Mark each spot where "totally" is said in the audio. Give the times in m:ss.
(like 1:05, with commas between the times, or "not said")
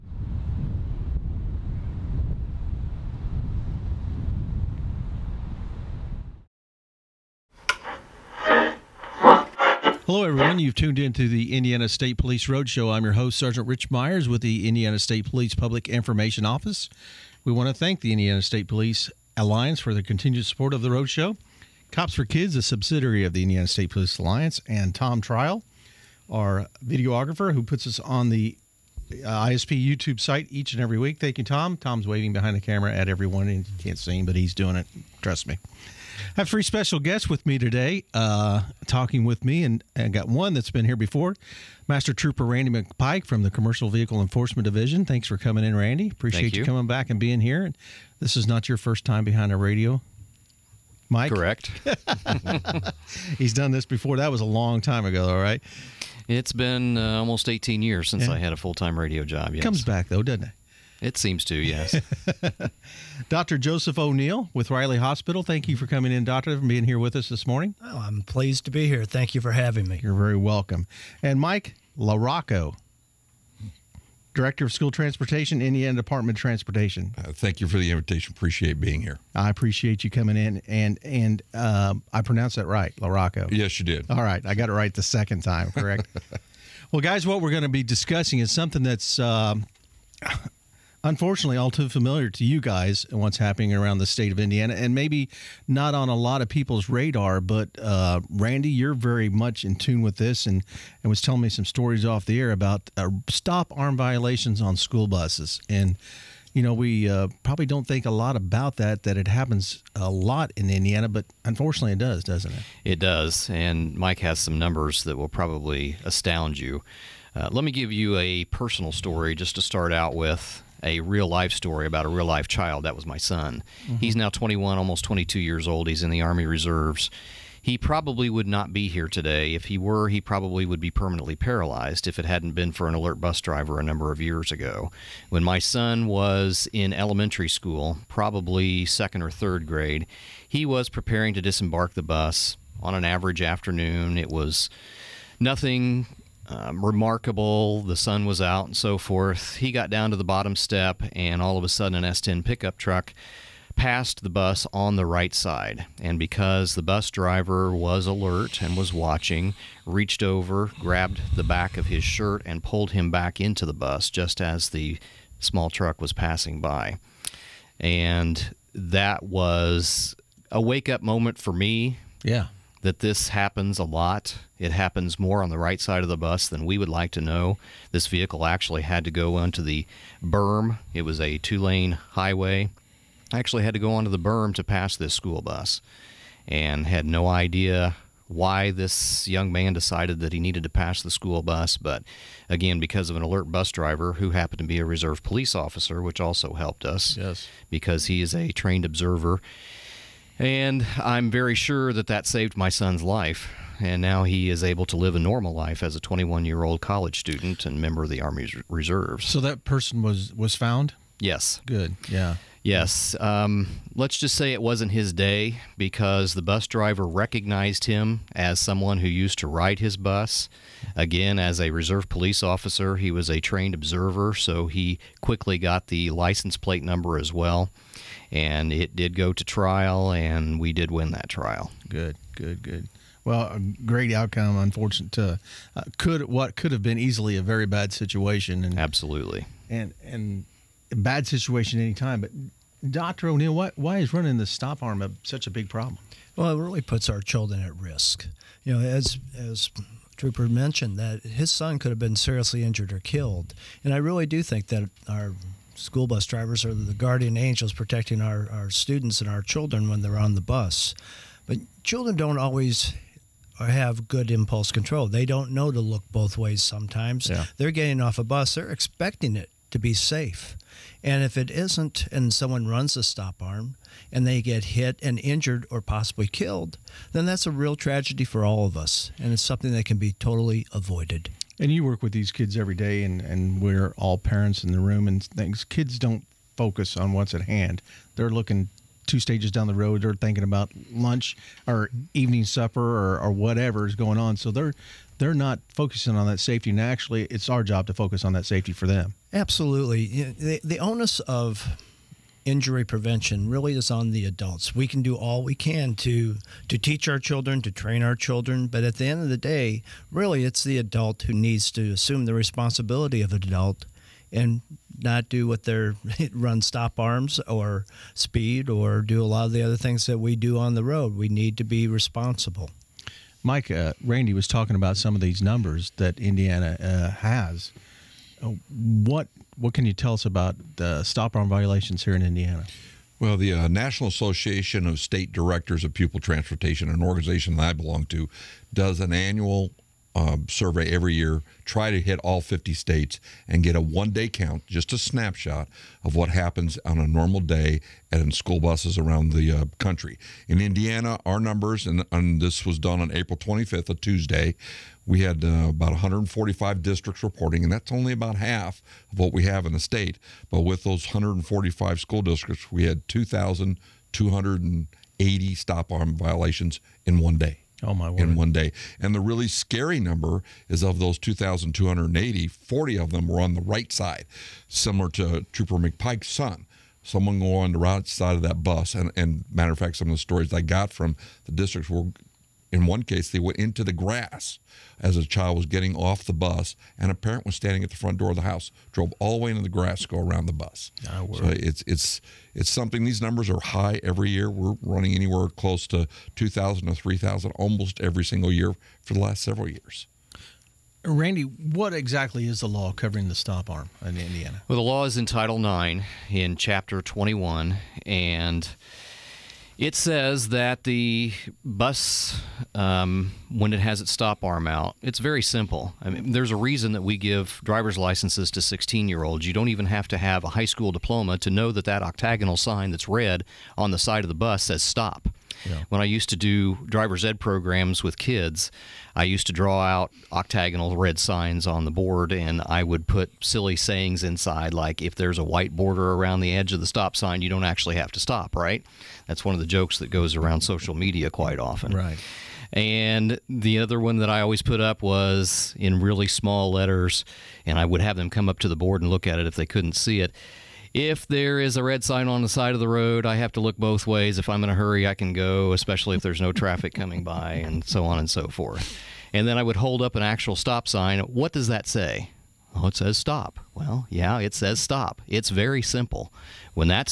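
4:40.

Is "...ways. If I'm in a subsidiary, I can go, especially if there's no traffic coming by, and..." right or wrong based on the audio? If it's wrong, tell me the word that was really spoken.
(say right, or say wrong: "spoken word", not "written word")
wrong: "hurry", not "subsidiary".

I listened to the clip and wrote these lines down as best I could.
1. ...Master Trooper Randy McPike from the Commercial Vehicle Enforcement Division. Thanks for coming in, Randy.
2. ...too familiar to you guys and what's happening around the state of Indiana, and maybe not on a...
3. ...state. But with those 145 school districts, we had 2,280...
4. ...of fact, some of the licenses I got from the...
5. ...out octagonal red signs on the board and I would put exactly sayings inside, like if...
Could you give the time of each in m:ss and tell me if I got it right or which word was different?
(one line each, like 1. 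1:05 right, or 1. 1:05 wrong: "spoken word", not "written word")
1. 0:41 right
2. 1:31 right
3. 5:59 right
4. 6:19 wrong: "stories", not "licenses"
5. 7:09 wrong: "silly", not "exactly".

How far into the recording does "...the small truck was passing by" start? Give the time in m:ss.
2:44.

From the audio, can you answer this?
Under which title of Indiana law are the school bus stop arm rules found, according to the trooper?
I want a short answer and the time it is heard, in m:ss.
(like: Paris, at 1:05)
Title IX, at 6:45.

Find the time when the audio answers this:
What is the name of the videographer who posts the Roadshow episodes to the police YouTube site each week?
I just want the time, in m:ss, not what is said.
0:24.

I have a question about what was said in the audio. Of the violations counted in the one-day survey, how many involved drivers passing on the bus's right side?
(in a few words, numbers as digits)
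40.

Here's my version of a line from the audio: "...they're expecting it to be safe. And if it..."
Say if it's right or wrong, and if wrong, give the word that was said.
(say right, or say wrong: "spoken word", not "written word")
right.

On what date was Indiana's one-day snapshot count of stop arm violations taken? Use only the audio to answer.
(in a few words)
April 25.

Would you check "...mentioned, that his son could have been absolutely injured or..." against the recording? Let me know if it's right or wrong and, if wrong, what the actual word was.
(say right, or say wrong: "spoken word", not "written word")
wrong: "seriously", not "absolutely".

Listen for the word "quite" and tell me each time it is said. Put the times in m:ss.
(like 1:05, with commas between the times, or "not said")
7:21.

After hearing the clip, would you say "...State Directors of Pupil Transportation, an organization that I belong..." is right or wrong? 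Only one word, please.
right.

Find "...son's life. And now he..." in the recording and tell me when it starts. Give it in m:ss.
3:22.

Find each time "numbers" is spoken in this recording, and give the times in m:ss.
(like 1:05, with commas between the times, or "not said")
1:54, 2:13, 3:46, 5:25, 5:51, 6:10, 6:33.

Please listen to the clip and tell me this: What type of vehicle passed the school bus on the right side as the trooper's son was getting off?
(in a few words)
S10 pickup truck.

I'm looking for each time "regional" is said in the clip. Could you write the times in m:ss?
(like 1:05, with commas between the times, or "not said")
not said.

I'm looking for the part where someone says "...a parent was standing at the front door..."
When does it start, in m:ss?
6:27.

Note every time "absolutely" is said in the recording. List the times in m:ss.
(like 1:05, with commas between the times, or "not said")
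3:58, 4:59.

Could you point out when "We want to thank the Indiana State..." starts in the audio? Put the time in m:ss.
0:17.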